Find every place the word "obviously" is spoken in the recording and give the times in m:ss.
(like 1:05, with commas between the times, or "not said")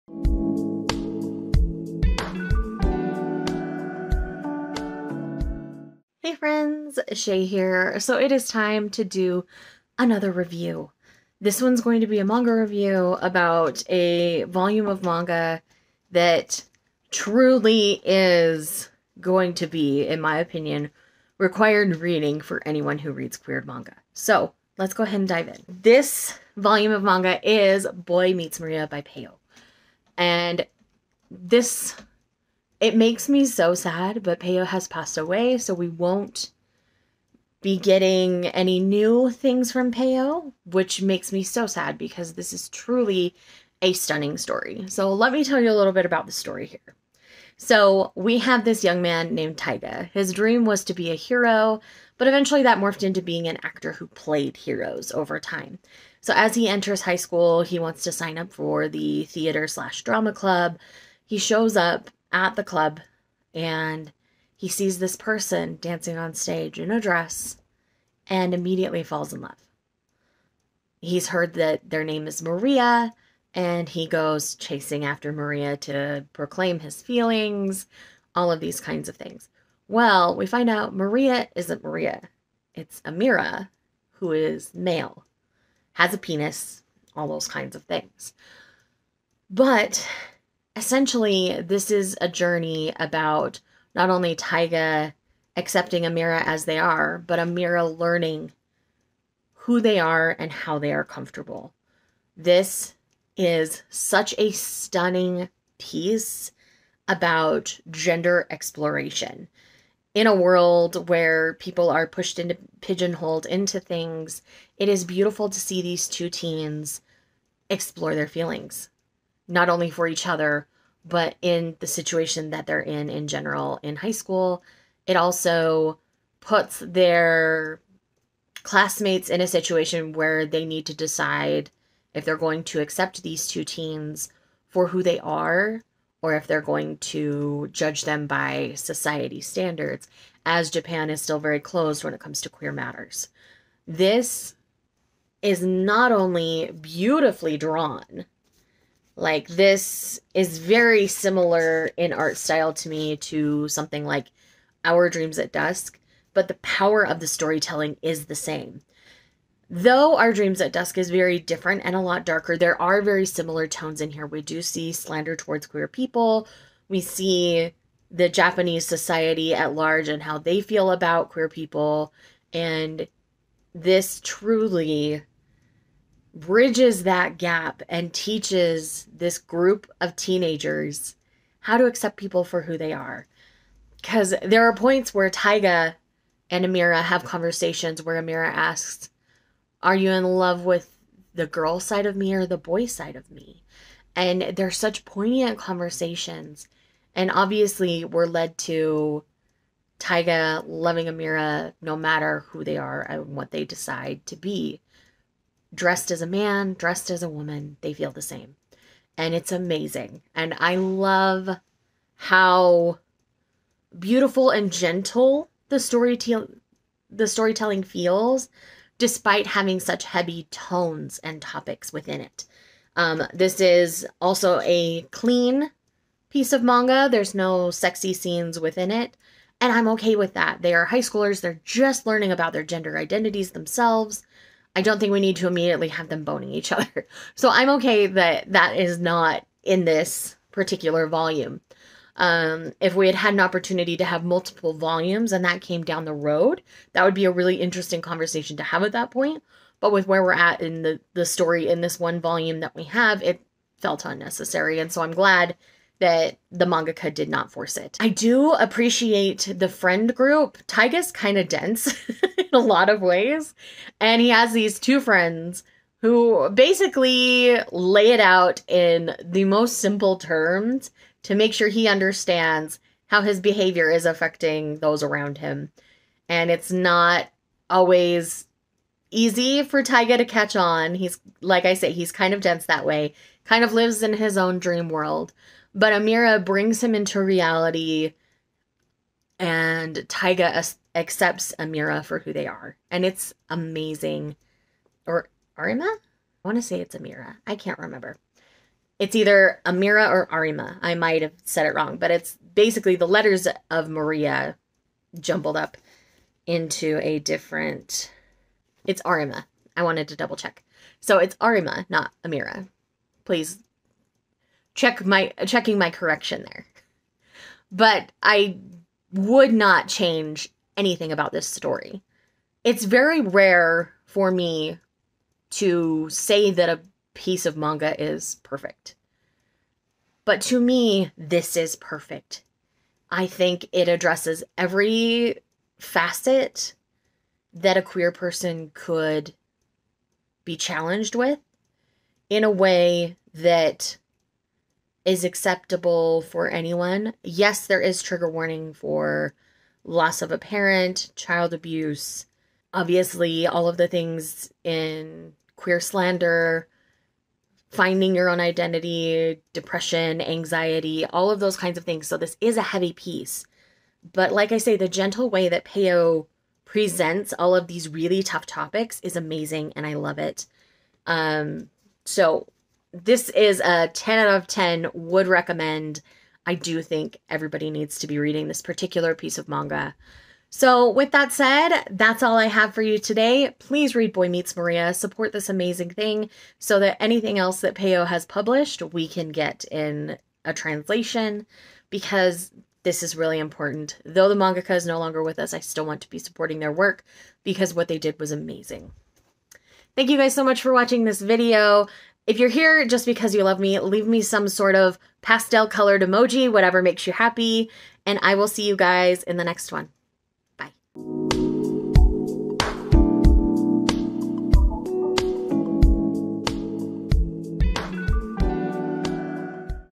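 3:17, 5:52.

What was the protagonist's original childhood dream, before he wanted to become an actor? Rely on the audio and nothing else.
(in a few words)
To be a hero.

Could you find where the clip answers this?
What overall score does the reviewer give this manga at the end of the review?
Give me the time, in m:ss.
6:13.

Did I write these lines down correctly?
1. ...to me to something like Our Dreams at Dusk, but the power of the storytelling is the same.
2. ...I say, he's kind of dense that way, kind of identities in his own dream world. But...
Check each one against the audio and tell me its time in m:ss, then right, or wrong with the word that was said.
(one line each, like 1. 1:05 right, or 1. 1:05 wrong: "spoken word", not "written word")
1. 2:32 right
2. 4:41 wrong: "lives", not "identities".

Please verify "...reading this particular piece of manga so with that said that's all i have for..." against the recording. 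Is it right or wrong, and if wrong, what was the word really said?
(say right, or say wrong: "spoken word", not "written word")
right.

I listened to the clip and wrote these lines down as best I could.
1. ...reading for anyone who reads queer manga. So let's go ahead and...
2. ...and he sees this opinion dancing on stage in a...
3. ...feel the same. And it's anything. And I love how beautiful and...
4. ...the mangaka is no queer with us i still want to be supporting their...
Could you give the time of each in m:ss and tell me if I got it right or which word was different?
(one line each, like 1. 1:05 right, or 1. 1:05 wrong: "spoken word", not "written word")
1. 0:21 right
2. 1:03 wrong: "person", not "opinion"
3. 3:27 wrong: "amazing", not "anything"
4. 6:34 wrong: "longer", not "queer".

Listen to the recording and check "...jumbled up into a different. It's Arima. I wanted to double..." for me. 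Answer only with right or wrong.
right.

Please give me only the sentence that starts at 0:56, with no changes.
So as he enters high school, he wants to sign up for the theater slash drama club.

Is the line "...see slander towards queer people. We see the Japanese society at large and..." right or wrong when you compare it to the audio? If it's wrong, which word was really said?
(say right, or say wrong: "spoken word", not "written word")
right.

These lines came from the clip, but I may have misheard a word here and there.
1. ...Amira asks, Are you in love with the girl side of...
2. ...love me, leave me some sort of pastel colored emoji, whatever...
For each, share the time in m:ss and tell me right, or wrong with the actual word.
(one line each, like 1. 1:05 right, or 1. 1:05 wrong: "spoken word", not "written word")
1. 3:08 right
2. 6:43 right.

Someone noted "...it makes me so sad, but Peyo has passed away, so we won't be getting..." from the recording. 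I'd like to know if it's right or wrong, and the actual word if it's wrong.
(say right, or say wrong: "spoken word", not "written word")
right.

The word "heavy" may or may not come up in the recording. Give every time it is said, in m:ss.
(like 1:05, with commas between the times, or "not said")
3:40, 6:02.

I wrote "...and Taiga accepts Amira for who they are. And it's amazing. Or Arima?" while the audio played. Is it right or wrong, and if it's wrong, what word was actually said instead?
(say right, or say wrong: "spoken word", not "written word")
right.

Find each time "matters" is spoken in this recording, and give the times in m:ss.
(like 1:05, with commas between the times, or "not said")
2:22, 3:21.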